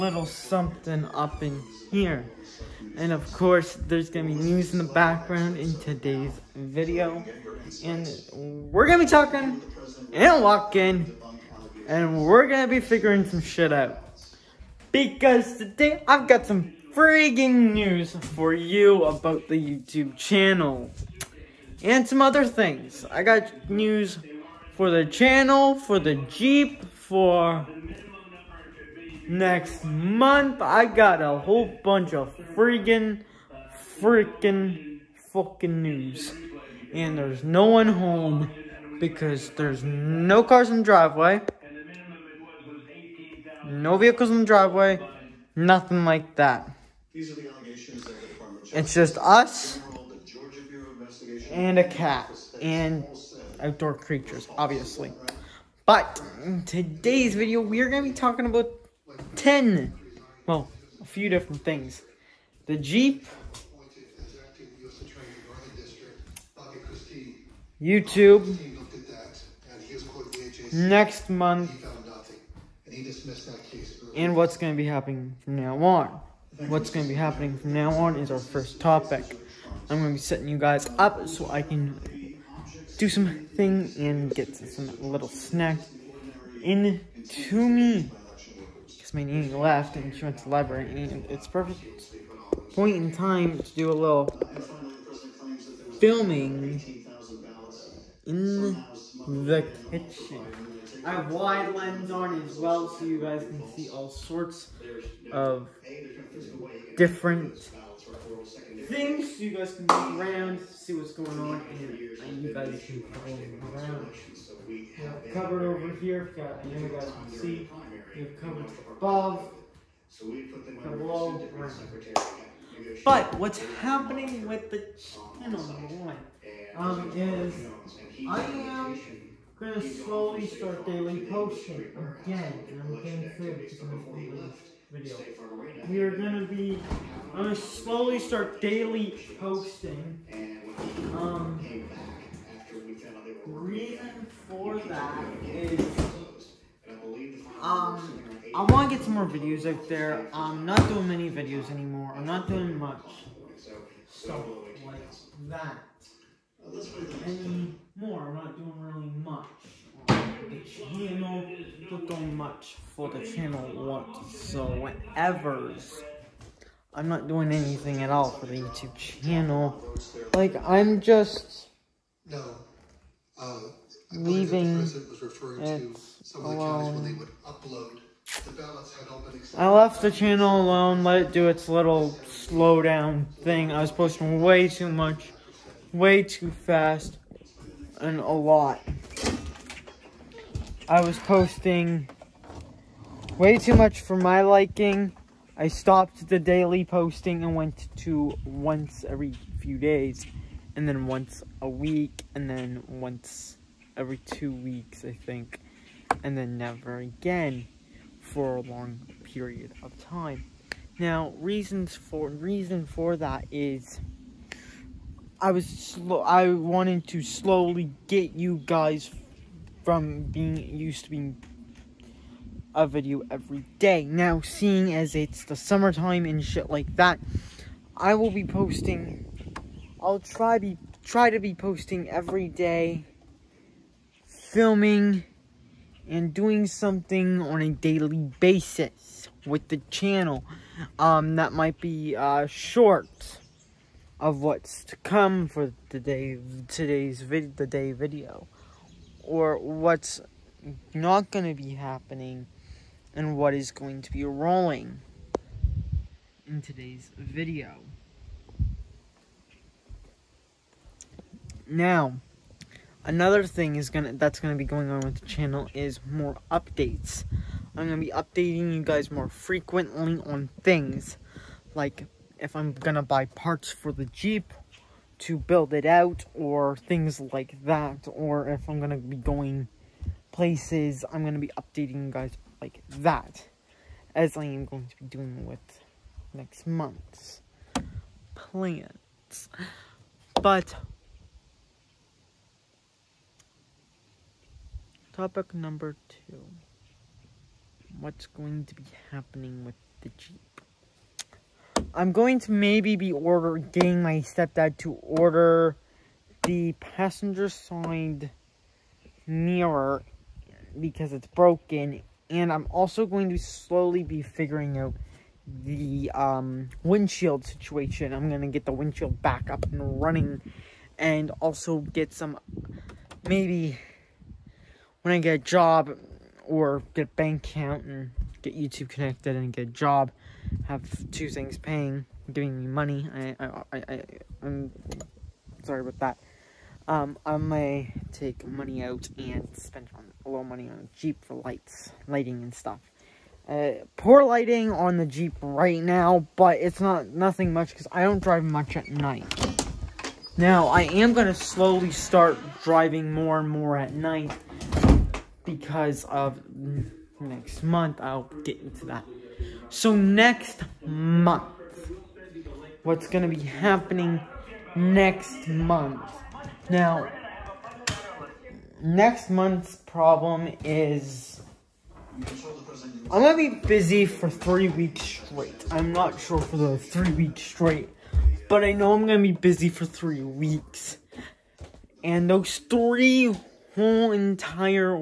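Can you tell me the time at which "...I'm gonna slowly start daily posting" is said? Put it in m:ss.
2:17.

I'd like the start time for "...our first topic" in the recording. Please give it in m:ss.
1:18.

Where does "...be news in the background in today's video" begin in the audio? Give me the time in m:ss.
0:04.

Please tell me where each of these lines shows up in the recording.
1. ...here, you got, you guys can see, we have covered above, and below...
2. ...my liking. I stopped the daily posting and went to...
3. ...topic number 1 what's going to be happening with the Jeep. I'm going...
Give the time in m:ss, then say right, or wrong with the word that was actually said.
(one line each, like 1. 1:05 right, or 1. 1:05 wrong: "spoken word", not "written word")
1. 1:55 right
2. 3:14 right
3. 4:55 wrong: "2", not "1".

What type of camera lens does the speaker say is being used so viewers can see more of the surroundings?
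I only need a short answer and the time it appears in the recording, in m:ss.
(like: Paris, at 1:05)
wide lens, at 1:41.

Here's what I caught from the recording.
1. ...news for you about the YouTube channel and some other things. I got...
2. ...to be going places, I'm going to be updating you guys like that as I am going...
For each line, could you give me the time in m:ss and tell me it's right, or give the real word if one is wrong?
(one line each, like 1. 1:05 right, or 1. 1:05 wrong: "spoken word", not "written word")
1. 0:17 right
2. 4:38 right.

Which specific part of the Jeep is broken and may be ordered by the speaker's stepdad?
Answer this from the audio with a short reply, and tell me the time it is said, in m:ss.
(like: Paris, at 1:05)
passenger side mirror, at 5:06.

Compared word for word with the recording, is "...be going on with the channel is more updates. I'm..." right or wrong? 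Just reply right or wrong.
right.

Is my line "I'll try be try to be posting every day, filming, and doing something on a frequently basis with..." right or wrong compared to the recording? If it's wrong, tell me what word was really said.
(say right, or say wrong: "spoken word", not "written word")
wrong: "daily", not "frequently".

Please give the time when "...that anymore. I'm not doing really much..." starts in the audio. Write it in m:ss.
2:35.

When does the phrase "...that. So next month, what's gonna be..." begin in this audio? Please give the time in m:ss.
5:58.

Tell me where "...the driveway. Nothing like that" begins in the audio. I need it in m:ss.
0:44.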